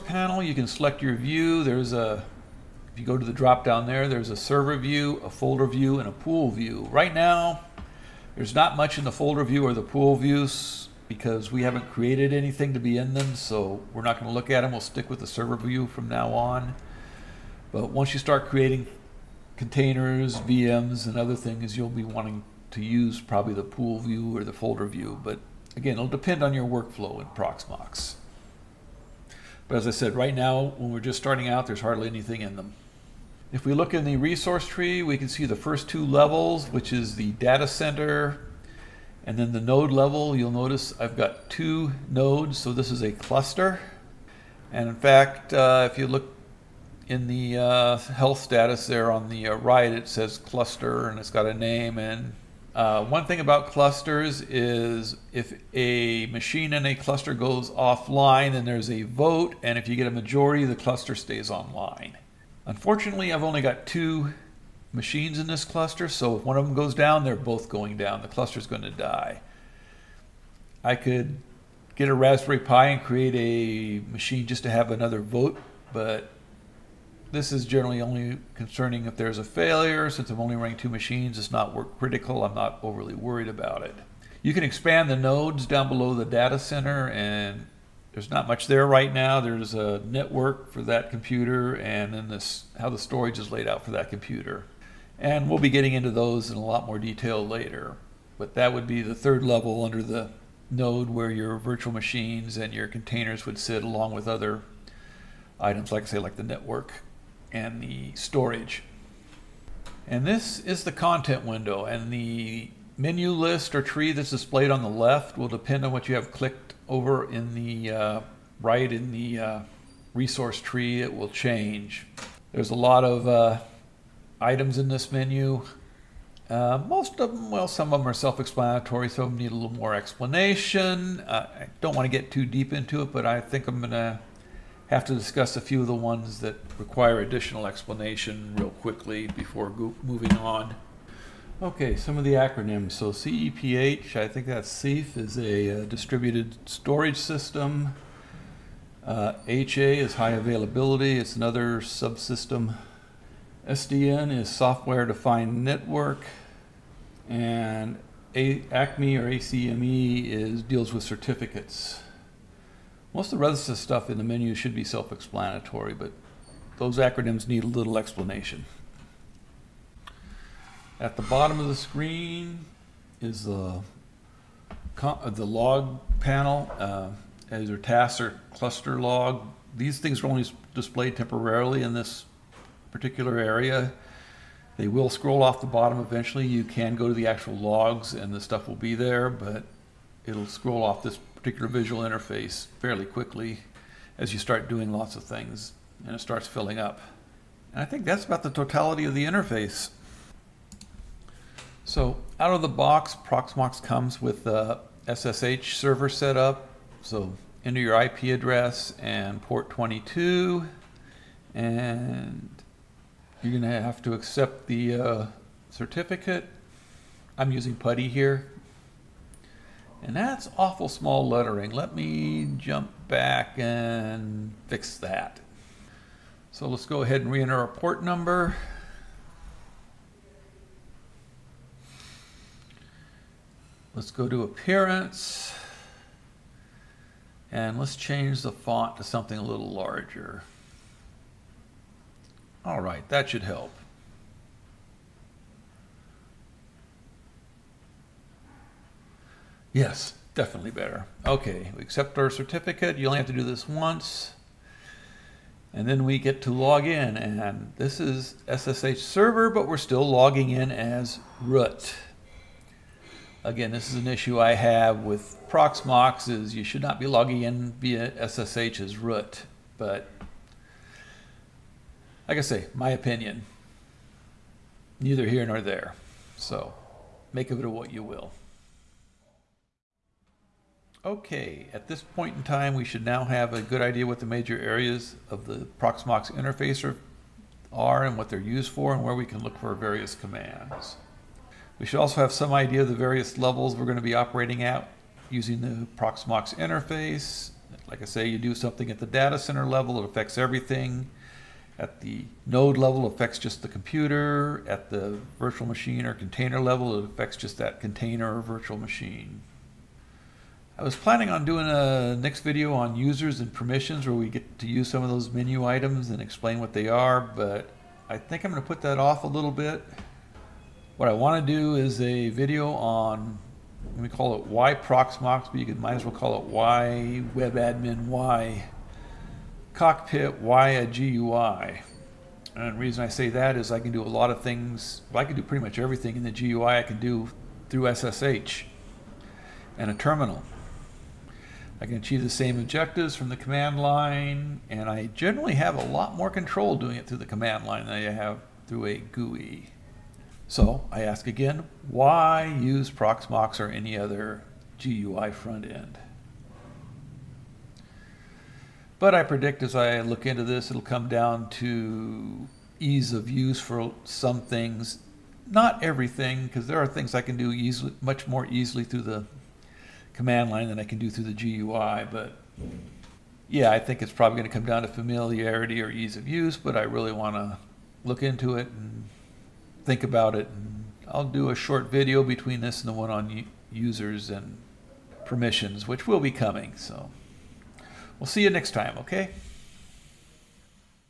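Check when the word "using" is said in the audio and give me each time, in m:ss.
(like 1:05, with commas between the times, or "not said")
3:37, 4:55.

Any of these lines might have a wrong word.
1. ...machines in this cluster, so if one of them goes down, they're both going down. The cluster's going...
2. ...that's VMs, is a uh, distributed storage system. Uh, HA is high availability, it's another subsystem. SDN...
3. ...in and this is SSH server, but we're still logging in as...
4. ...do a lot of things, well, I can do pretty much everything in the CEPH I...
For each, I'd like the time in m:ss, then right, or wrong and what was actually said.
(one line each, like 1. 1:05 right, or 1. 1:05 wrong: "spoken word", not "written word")
1. 1:04 right
2. 2:24 wrong: "CEF", not "VMs"
3. 4:16 right
4. 5:33 wrong: "GUI", not "CEPH".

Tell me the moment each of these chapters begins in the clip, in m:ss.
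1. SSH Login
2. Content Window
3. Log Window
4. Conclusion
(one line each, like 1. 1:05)
1. 3:28
2. 1:58
3. 2:58
4. 4:33.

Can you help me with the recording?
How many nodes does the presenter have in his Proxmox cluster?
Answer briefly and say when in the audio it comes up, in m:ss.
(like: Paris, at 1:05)
2, at 0:41.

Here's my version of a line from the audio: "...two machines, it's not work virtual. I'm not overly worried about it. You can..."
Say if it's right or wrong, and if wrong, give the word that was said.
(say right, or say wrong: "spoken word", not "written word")
wrong: "critical", not "virtual".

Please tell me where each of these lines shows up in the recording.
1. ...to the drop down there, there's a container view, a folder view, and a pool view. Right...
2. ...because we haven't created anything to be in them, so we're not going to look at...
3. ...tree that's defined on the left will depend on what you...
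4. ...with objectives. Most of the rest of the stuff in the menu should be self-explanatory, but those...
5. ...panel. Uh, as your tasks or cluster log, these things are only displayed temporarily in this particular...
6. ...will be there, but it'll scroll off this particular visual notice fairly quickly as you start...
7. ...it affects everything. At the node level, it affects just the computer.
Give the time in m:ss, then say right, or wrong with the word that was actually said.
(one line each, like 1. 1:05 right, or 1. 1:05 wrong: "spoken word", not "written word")
1. 0:03 wrong: "server", not "container"
2. 0:11 right
3. 1:53 wrong: "displayed", not "defined"
4. 2:40 wrong: "certificates", not "objectives"
5. 2:56 right
6. 3:08 wrong: "interface", not "notice"
7. 5:00 right.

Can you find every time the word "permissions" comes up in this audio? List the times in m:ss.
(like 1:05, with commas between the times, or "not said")
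5:13, 6:25.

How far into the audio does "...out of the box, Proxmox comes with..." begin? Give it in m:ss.
3:22.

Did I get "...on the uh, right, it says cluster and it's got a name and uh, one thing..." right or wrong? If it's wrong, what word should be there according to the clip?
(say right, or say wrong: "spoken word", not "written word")
right.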